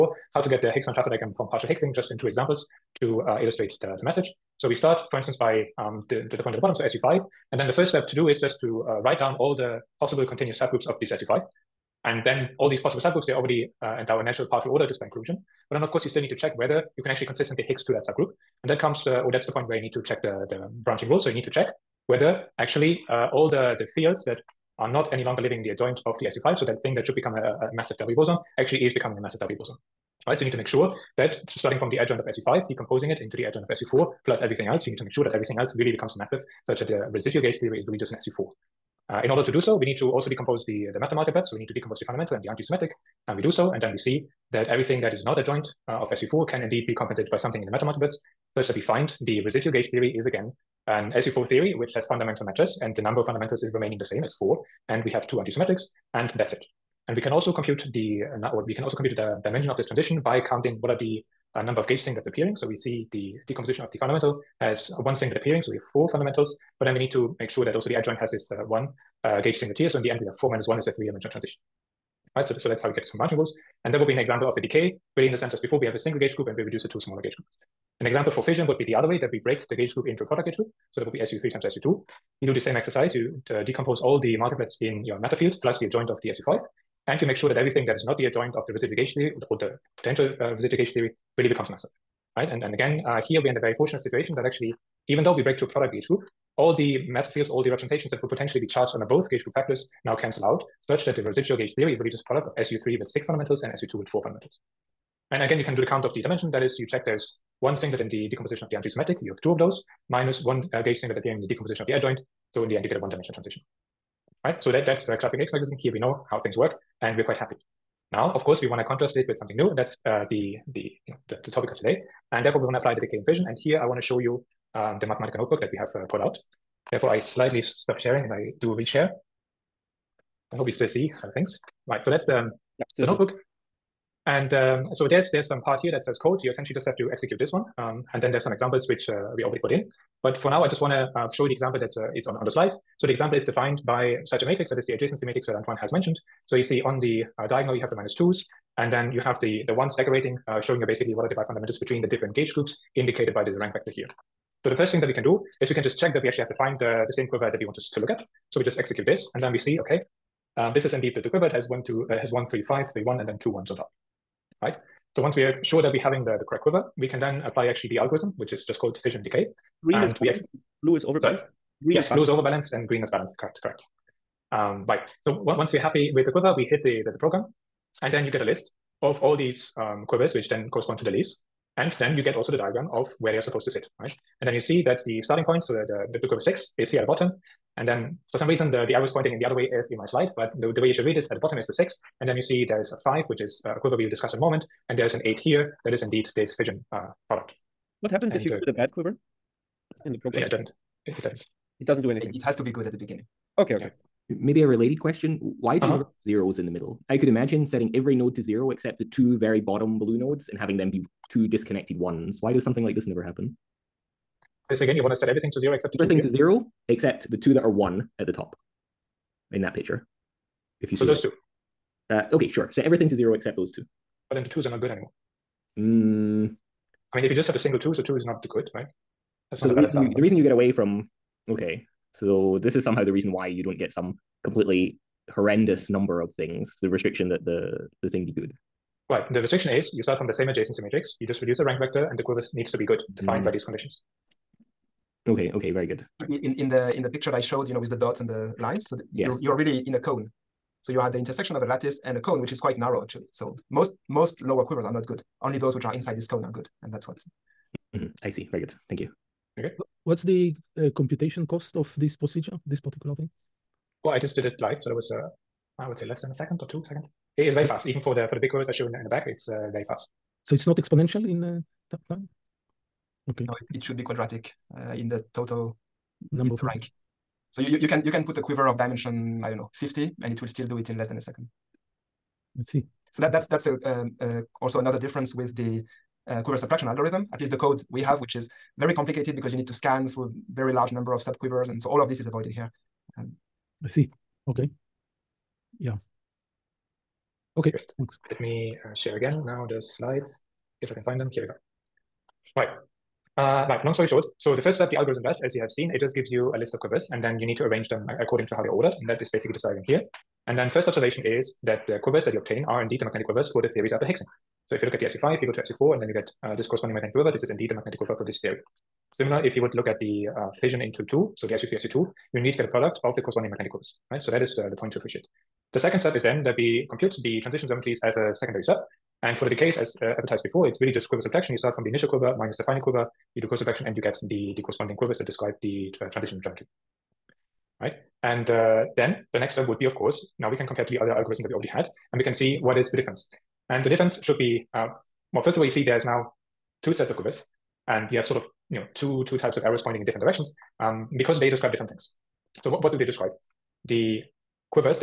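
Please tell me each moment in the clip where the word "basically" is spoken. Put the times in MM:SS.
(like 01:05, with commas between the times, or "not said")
02:30, 05:09.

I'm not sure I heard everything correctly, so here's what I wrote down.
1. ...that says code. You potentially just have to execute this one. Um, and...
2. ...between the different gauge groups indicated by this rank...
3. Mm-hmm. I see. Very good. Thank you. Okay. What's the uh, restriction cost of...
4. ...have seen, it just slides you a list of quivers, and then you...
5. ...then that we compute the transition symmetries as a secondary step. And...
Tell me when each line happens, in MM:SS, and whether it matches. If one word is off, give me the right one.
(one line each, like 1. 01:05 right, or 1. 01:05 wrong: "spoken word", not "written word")
1. 02:15 wrong: "essentially", not "potentially"
2. 02:31 right
3. 04:17 wrong: "computation", not "restriction"
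4. 05:05 wrong: "gives", not "slides"
5. 05:26 right.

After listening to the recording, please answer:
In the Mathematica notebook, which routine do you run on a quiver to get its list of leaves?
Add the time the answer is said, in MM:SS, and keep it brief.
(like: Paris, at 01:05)
fission decay, at 02:49.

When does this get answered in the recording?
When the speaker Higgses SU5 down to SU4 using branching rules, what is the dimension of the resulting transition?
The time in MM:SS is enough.
01:10.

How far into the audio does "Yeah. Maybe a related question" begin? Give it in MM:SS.
03:24.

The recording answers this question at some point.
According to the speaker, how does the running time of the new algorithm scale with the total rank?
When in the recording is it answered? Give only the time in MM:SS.
04:34.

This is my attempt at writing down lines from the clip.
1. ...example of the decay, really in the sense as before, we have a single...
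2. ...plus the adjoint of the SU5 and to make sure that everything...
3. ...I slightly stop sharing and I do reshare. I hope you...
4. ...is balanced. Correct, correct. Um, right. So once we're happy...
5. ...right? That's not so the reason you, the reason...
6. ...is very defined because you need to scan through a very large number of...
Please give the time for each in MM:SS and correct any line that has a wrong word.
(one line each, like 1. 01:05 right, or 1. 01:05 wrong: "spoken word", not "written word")
1. 01:14 right
2. 01:25 right
3. 02:07 right
4. 02:53 right
5. 03:48 right
6. 04:48 wrong: "complicated", not "defined".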